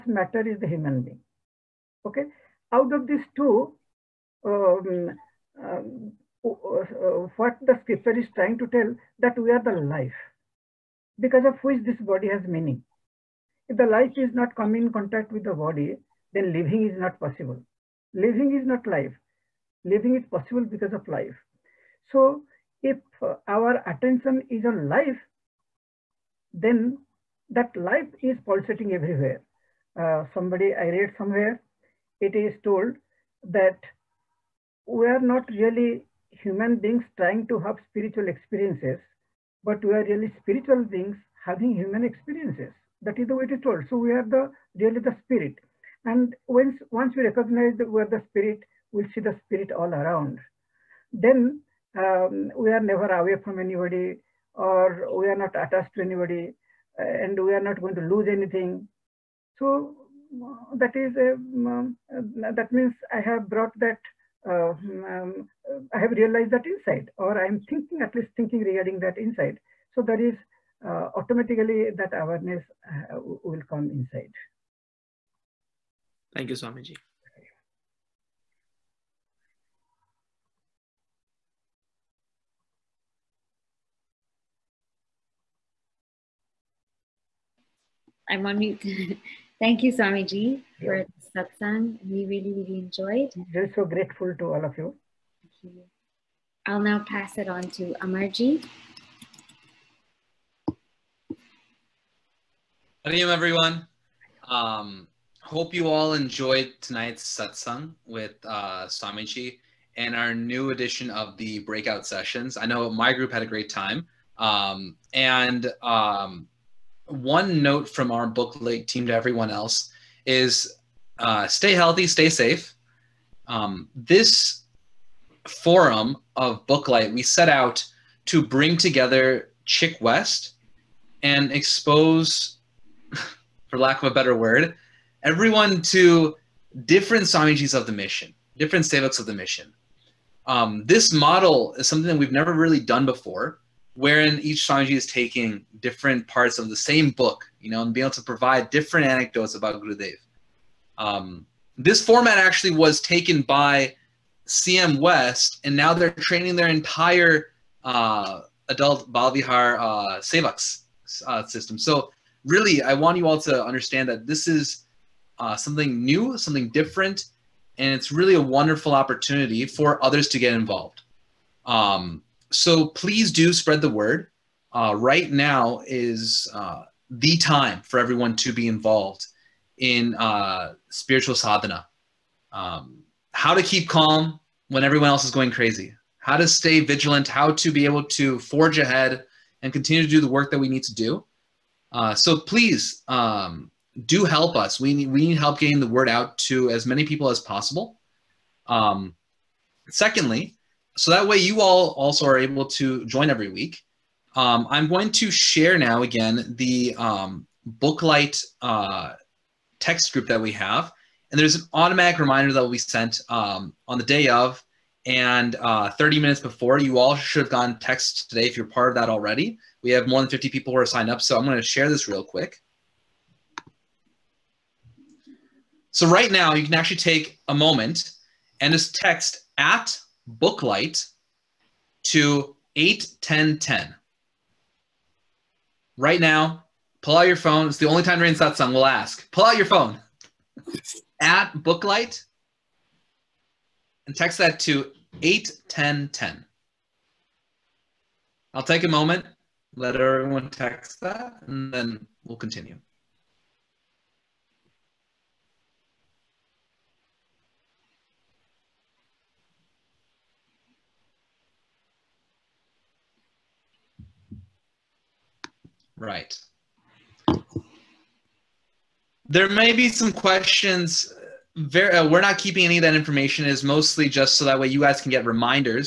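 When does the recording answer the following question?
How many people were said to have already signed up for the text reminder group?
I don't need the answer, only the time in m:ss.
3:40.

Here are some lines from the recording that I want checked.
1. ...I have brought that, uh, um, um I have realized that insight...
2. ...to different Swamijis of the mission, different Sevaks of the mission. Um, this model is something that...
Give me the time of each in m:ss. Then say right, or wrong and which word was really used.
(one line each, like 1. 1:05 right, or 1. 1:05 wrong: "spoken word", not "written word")
1. 1:03 right
2. 2:15 right.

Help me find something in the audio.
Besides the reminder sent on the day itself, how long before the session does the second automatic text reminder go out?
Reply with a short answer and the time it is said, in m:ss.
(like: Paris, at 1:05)
30 minutes, at 3:35.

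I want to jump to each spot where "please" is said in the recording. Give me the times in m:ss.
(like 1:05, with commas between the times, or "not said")
2:52, 3:12.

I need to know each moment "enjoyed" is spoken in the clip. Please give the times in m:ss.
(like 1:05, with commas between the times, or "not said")
1:32, 1:46.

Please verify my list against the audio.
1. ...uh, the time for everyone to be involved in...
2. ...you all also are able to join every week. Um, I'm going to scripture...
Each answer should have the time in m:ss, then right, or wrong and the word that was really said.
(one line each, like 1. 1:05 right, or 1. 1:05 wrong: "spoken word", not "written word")
1. 2:56 right
2. 3:21 wrong: "share", not "scripture".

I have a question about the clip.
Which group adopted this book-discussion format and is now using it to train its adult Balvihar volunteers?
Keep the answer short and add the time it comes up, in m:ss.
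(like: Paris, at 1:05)
CM West, at 2:34.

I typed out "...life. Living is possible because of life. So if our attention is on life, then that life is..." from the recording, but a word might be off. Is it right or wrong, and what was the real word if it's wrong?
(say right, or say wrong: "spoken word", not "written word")
right.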